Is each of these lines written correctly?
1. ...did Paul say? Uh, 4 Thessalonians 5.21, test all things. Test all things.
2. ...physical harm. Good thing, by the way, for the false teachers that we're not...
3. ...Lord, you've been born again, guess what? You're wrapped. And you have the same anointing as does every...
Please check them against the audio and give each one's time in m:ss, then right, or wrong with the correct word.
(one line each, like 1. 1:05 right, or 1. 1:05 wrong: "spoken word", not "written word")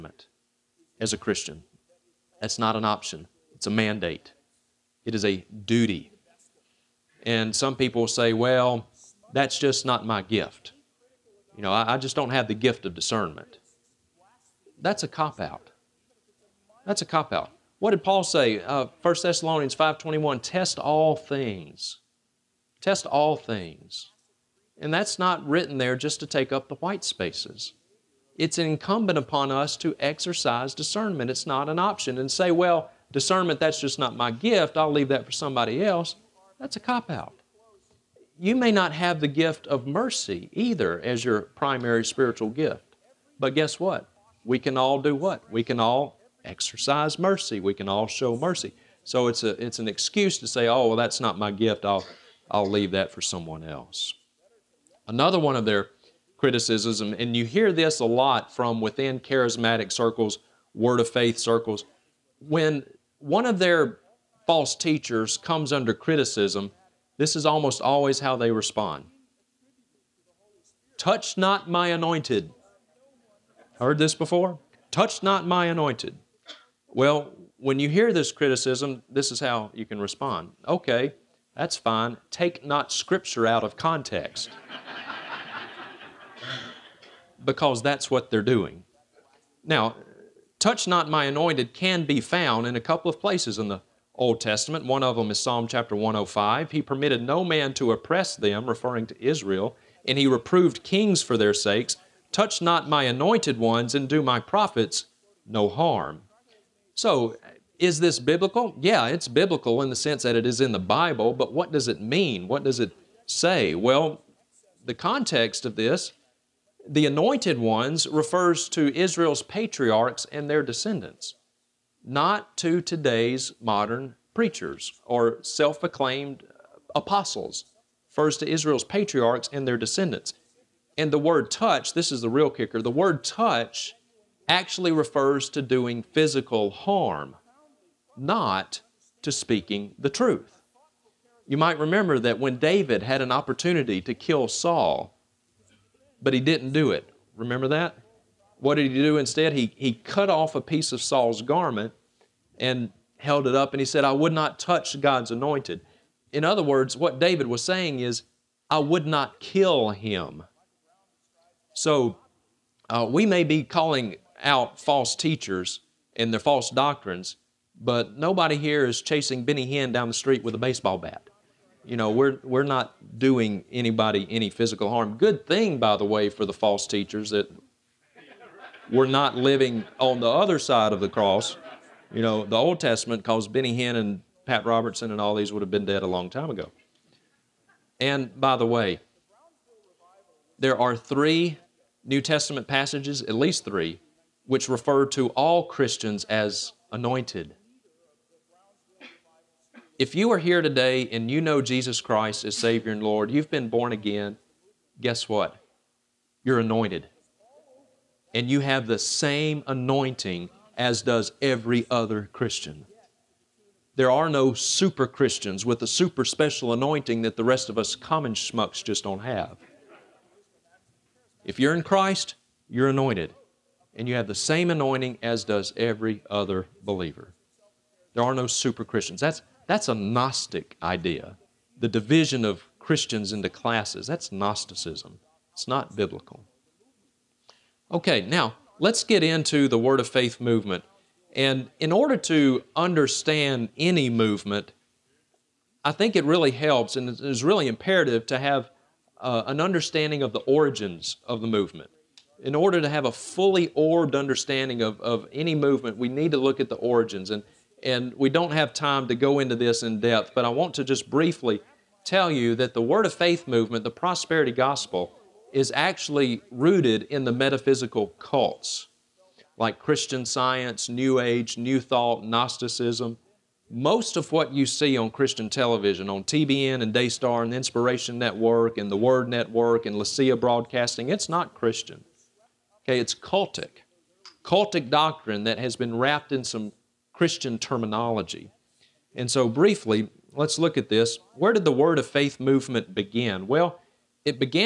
1. 0:17 wrong: "1", not "4"
2. 2:54 right
3. 3:23 wrong: "anointed", not "wrapped".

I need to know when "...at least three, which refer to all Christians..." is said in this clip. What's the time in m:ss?
3:13.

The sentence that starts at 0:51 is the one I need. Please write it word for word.
I'll, I'll leave that for someone else.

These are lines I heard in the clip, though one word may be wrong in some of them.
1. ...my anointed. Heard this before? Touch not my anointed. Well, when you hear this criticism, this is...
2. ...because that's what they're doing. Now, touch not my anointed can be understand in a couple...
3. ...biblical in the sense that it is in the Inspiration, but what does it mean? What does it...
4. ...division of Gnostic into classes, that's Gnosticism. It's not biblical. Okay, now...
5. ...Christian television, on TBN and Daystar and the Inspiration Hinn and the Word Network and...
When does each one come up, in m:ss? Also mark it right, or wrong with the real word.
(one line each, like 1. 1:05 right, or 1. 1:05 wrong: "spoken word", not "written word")
1. 1:11 right
2. 1:27 wrong: "found", not "understand"
3. 1:49 wrong: "Bible", not "Inspiration"
4. 3:51 wrong: "Christians", not "Gnostic"
5. 4:35 wrong: "Network", not "Hinn".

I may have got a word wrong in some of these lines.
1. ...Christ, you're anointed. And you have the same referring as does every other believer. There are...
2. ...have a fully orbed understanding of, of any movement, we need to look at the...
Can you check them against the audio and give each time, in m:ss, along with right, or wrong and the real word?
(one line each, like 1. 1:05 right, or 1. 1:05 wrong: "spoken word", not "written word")
1. 3:41 wrong: "anointing", not "referring"
2. 4:12 right.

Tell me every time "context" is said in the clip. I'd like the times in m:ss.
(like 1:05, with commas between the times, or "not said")
1:23, 1:54.